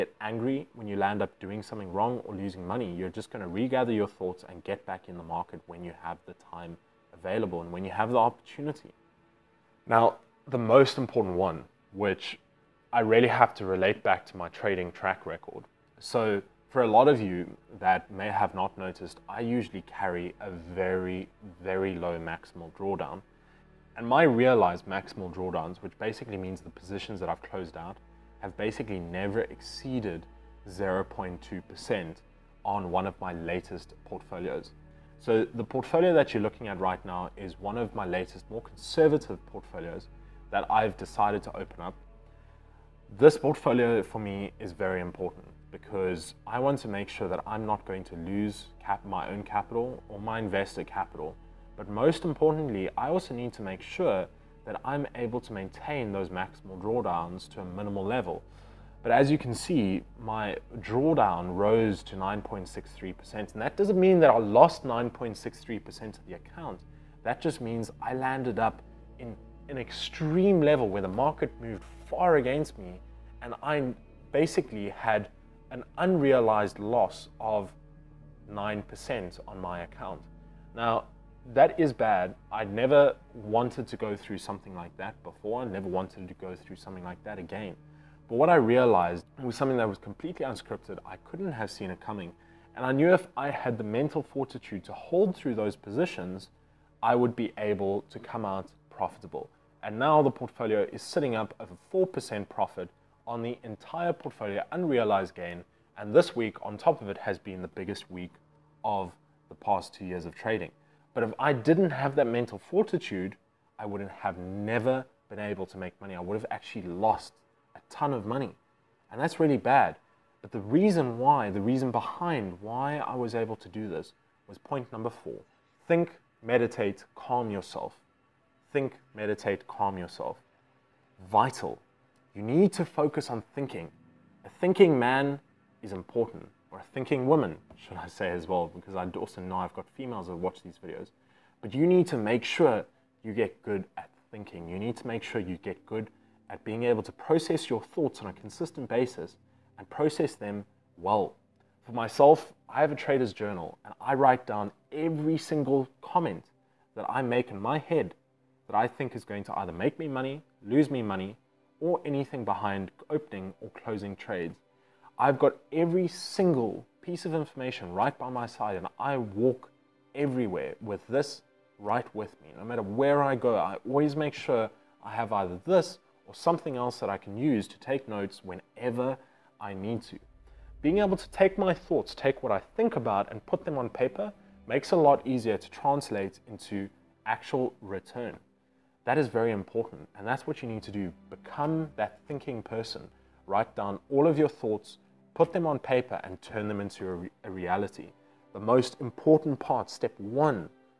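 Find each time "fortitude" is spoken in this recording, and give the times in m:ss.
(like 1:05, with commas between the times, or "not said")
1:34, 1:52.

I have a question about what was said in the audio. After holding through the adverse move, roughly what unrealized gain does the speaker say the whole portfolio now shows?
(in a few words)
over 4%.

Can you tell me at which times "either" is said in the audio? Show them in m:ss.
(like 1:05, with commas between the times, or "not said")
2:39, 2:55.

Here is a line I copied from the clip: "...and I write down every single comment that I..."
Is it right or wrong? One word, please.
right.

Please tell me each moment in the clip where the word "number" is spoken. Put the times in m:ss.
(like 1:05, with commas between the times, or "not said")
2:04.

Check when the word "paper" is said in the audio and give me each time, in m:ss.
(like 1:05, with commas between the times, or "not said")
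3:03, 3:15.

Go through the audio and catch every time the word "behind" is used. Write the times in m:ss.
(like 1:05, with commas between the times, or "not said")
2:01, 2:42.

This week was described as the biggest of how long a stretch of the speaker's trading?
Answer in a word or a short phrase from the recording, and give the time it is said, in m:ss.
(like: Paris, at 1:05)
2 years, at 1:49.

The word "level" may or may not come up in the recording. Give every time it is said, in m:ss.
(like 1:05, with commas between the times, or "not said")
0:58, 1:10.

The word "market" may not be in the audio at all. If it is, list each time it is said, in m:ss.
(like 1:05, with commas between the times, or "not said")
0:05, 1:11.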